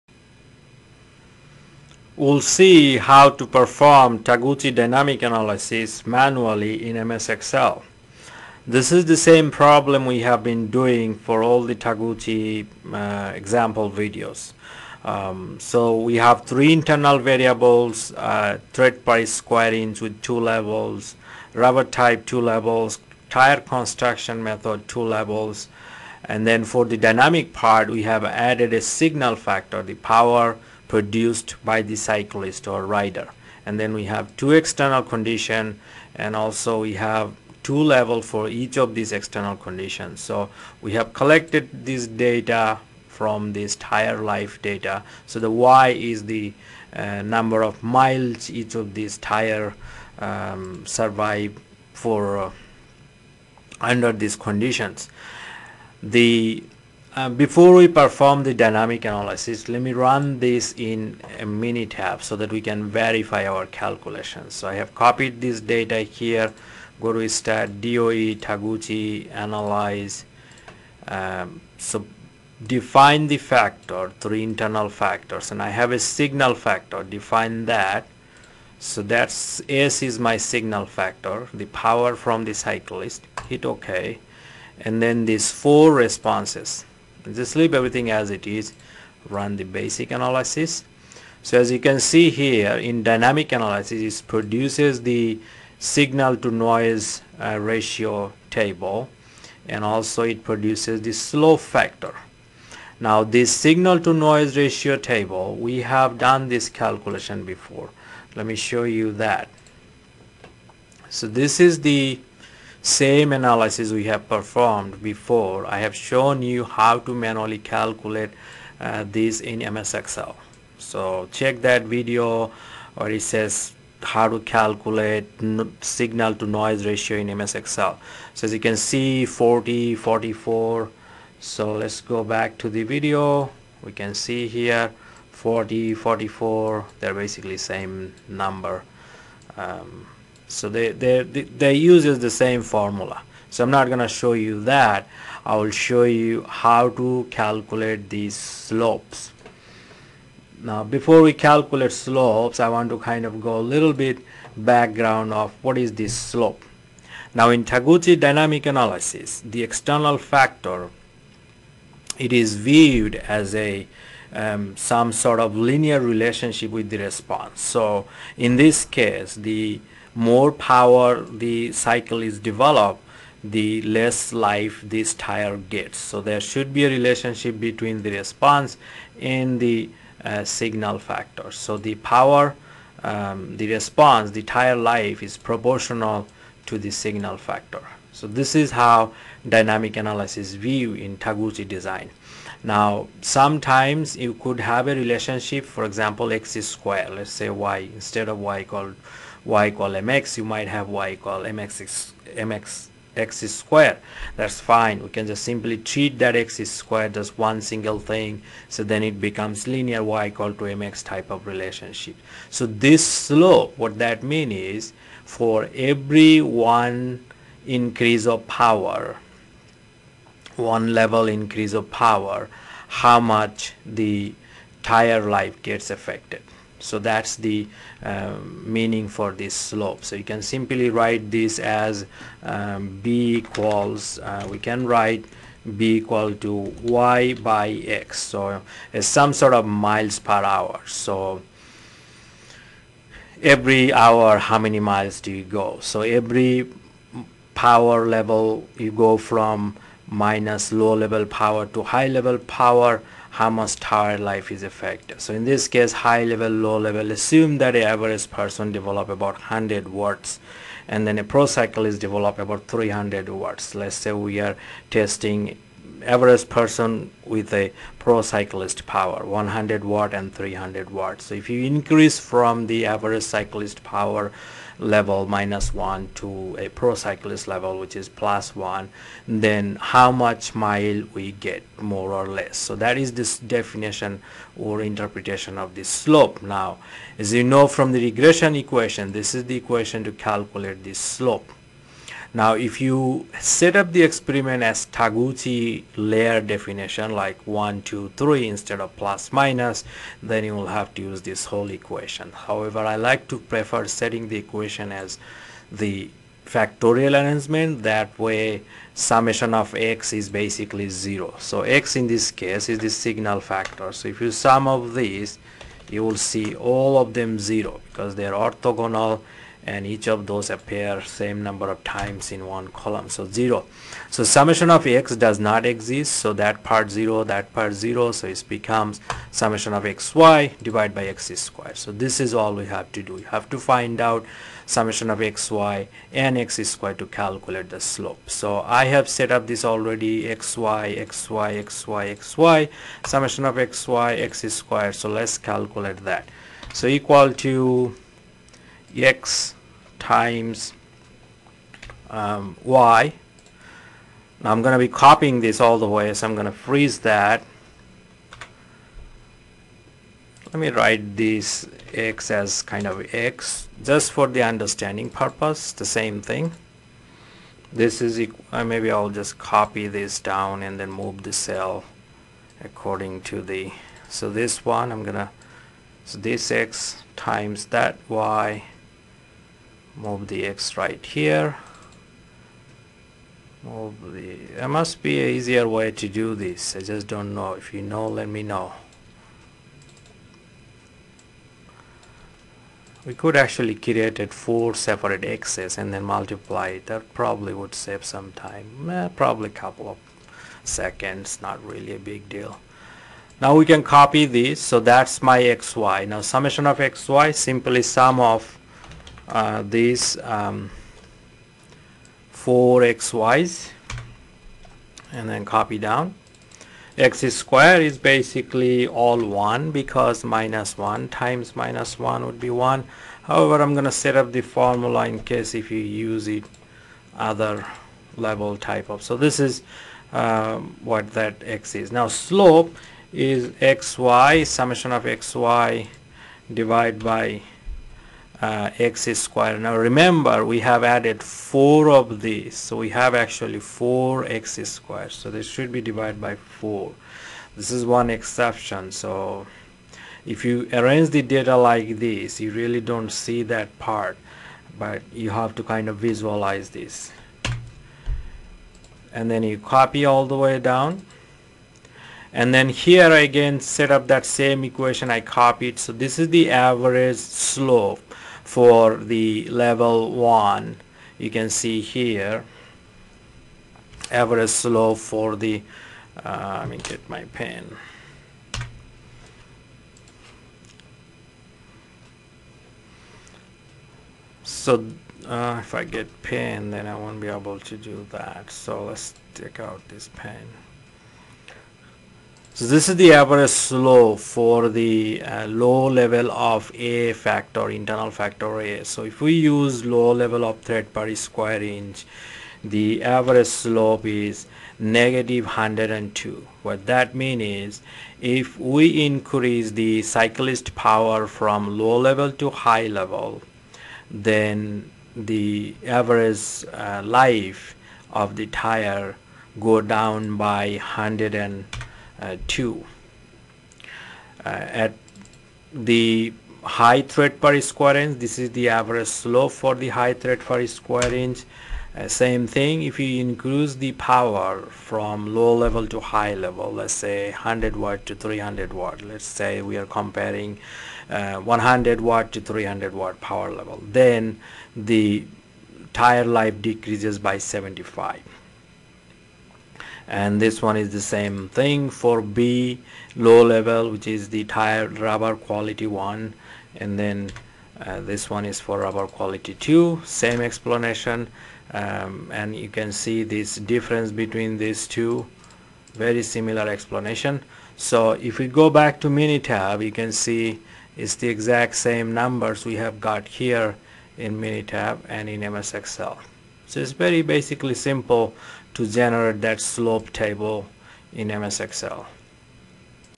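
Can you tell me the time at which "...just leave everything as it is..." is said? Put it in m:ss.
1:27.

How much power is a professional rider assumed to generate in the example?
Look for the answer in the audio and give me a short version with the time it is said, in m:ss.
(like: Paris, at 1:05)
300 watts, at 4:22.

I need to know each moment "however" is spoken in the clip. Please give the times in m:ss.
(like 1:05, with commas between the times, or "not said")
5:02, 7:03.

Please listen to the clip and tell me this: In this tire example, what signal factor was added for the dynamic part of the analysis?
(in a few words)
Power produced by the cyclist.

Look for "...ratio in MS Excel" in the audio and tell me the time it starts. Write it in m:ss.
2:06.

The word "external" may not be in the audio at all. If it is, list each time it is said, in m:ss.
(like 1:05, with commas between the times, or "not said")
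0:34, 0:39, 2:39.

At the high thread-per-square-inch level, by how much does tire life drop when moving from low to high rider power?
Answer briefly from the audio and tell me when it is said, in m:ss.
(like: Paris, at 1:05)
75, at 9:07.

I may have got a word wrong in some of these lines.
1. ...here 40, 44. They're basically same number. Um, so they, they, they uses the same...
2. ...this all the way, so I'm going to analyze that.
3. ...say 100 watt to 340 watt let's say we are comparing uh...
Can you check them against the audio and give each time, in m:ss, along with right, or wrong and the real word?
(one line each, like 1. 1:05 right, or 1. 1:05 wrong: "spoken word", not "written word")
1. 2:14 right
2. 5:55 wrong: "freeze", not "analyze"
3. 8:56 wrong: "300", not "340".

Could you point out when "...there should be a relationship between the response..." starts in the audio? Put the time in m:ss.
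2:56.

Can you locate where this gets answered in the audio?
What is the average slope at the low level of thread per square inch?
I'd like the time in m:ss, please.
8:24.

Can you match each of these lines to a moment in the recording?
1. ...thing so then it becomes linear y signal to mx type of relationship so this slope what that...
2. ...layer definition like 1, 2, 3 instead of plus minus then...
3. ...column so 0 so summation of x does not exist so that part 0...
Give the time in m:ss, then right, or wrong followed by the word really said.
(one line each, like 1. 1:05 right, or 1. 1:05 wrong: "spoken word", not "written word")
1. 3:27 wrong: "equal", not "signal"
2. 4:55 right
3. 5:22 right.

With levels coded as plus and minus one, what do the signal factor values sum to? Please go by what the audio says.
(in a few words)
0.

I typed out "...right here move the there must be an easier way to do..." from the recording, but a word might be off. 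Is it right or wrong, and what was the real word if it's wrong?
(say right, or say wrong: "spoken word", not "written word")
right.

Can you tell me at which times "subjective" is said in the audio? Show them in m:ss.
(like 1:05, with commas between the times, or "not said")
not said.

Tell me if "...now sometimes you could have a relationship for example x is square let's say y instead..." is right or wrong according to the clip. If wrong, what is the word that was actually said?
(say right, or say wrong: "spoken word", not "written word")
right.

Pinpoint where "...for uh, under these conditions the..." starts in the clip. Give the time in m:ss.
0:51.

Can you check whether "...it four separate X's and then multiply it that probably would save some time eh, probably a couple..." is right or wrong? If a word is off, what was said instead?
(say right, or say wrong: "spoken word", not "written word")
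right.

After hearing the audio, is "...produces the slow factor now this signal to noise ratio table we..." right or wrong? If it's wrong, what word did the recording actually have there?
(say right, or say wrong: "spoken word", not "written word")
right.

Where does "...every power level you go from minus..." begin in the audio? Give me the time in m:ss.
4:06.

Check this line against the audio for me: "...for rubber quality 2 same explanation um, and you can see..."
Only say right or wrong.
right.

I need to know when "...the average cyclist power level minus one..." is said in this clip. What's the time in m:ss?
4:32.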